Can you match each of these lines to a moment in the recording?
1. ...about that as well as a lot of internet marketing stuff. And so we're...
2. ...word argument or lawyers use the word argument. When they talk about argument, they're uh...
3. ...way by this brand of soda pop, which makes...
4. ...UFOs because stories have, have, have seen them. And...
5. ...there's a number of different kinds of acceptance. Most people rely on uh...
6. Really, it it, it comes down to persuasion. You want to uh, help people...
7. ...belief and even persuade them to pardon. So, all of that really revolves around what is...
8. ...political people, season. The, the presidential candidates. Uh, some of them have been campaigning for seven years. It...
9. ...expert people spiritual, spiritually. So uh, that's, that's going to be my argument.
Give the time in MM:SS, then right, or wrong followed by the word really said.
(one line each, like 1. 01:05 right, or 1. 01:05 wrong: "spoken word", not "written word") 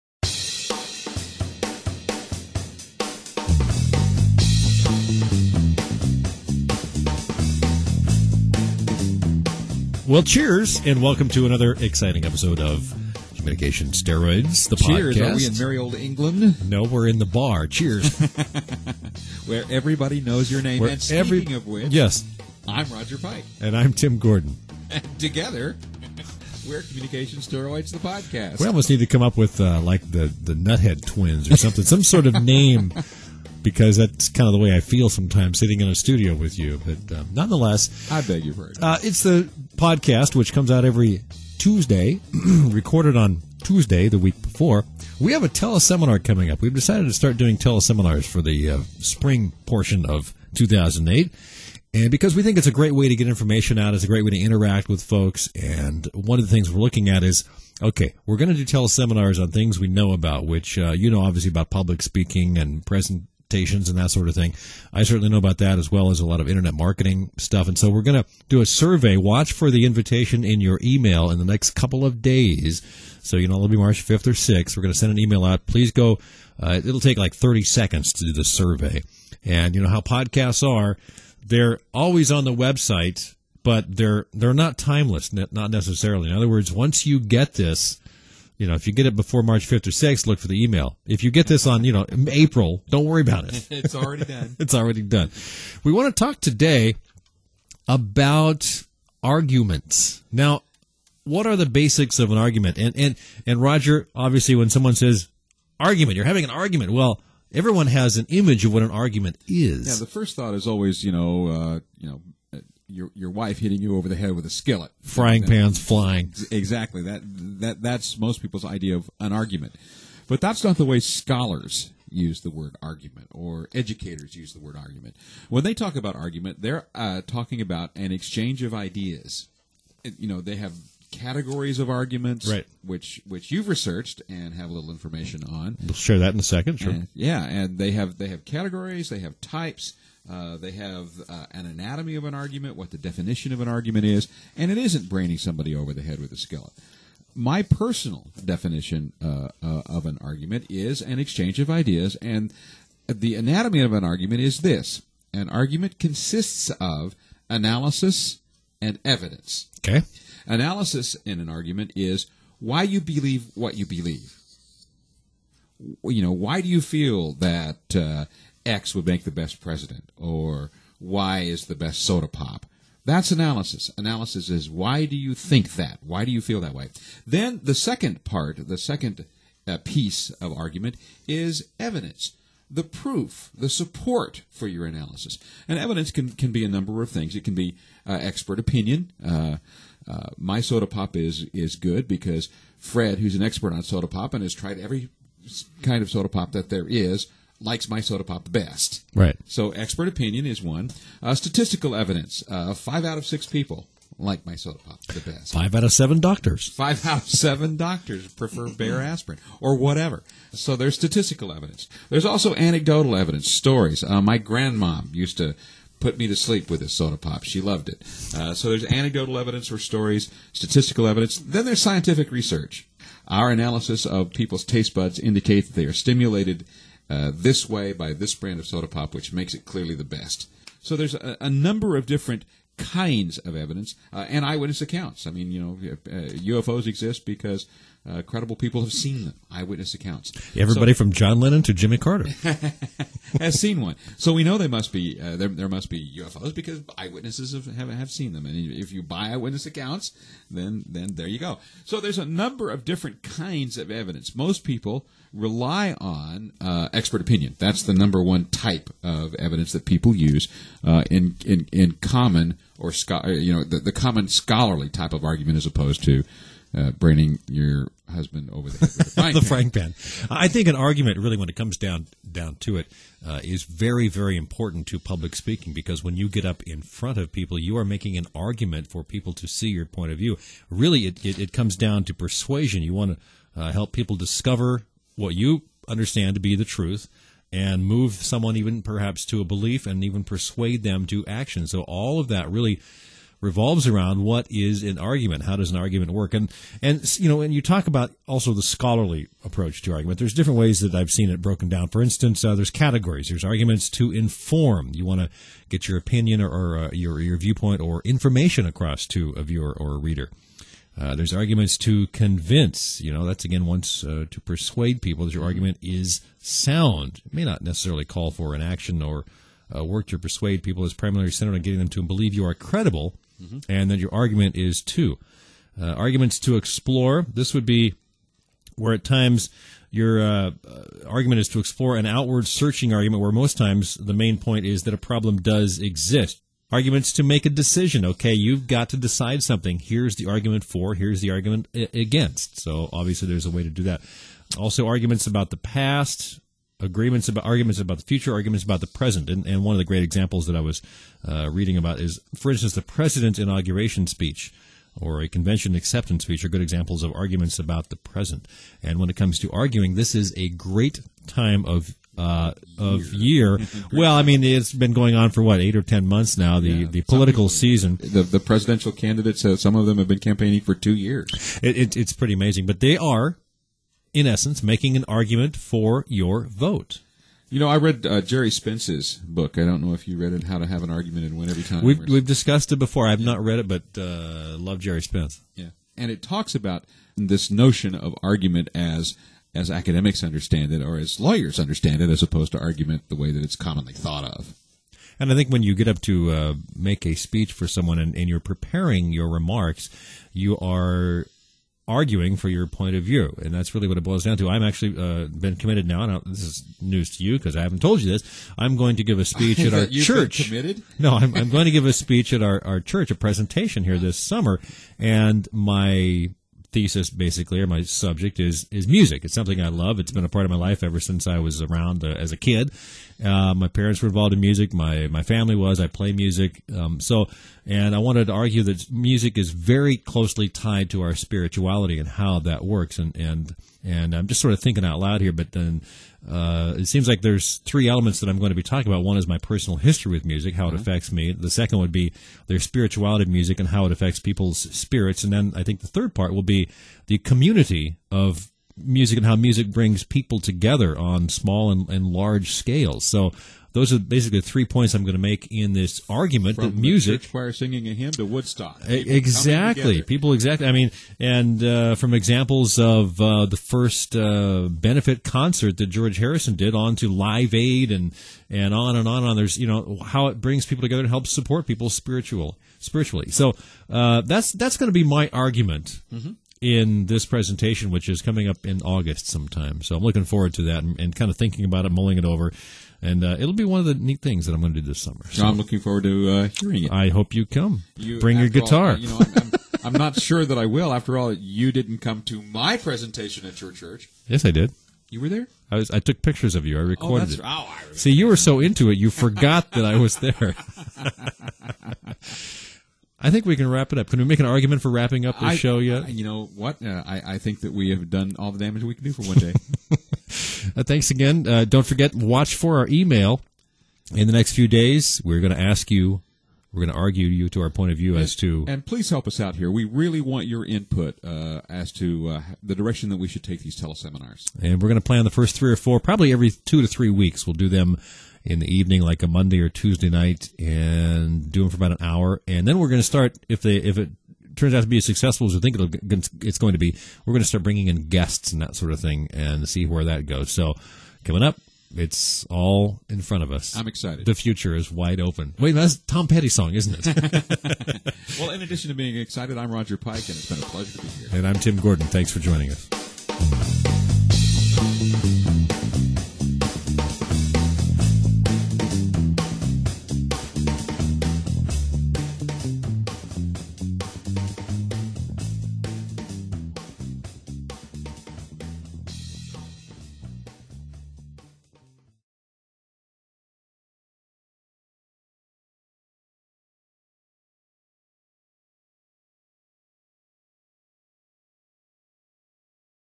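1. 01:05 right
2. 02:02 wrong: "educators", not "lawyers"
3. 03:47 right
4. 04:06 wrong: "eyewitnesses", not "stories"
5. 04:11 wrong: "evidence", not "acceptance"
6. 04:40 right
7. 04:49 wrong: "action", not "pardon"
8. 06:07 wrong: "two", not "seven"
9. 07:51 wrong: "support", not "expert".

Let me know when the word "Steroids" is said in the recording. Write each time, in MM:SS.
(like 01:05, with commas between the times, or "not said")
00:13, 00:27.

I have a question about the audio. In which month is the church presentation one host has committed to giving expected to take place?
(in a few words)
August.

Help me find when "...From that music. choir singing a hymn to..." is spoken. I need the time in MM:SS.
07:36.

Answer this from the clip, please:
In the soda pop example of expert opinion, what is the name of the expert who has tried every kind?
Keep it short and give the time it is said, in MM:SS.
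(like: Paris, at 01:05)
Fred, at 03:12.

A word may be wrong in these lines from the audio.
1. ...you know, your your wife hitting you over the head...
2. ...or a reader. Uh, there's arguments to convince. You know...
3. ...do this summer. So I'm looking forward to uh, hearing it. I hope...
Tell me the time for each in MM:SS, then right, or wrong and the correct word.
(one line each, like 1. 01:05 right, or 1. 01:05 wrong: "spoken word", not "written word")
1. 01:51 right
2. 05:09 right
3. 08:04 right.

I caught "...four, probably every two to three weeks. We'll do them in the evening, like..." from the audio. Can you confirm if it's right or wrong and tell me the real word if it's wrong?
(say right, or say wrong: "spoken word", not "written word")
right.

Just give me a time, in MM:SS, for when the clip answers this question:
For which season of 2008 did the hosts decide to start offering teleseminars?
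00:48.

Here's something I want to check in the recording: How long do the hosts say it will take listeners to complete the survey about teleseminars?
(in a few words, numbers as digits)
30 seconds.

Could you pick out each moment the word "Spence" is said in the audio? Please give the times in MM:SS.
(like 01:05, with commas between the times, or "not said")
06:18, 06:25.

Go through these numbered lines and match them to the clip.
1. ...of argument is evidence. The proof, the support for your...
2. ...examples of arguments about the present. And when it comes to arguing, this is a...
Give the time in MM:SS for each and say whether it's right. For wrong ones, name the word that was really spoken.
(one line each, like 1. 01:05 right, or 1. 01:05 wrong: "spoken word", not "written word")
1. 03:00 right
2. 05:56 right.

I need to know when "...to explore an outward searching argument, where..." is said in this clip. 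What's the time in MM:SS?
05:31.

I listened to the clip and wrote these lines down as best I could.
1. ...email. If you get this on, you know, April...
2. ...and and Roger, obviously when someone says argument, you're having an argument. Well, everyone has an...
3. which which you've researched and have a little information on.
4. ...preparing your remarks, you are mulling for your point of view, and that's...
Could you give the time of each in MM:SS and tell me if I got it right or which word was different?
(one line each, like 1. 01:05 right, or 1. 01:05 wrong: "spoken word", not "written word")
1. 01:30 right
2. 01:42 right
3. 02:12 right
4. 06:38 wrong: "arguing", not "mulling".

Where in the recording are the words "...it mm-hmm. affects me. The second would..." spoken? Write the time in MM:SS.
07:20.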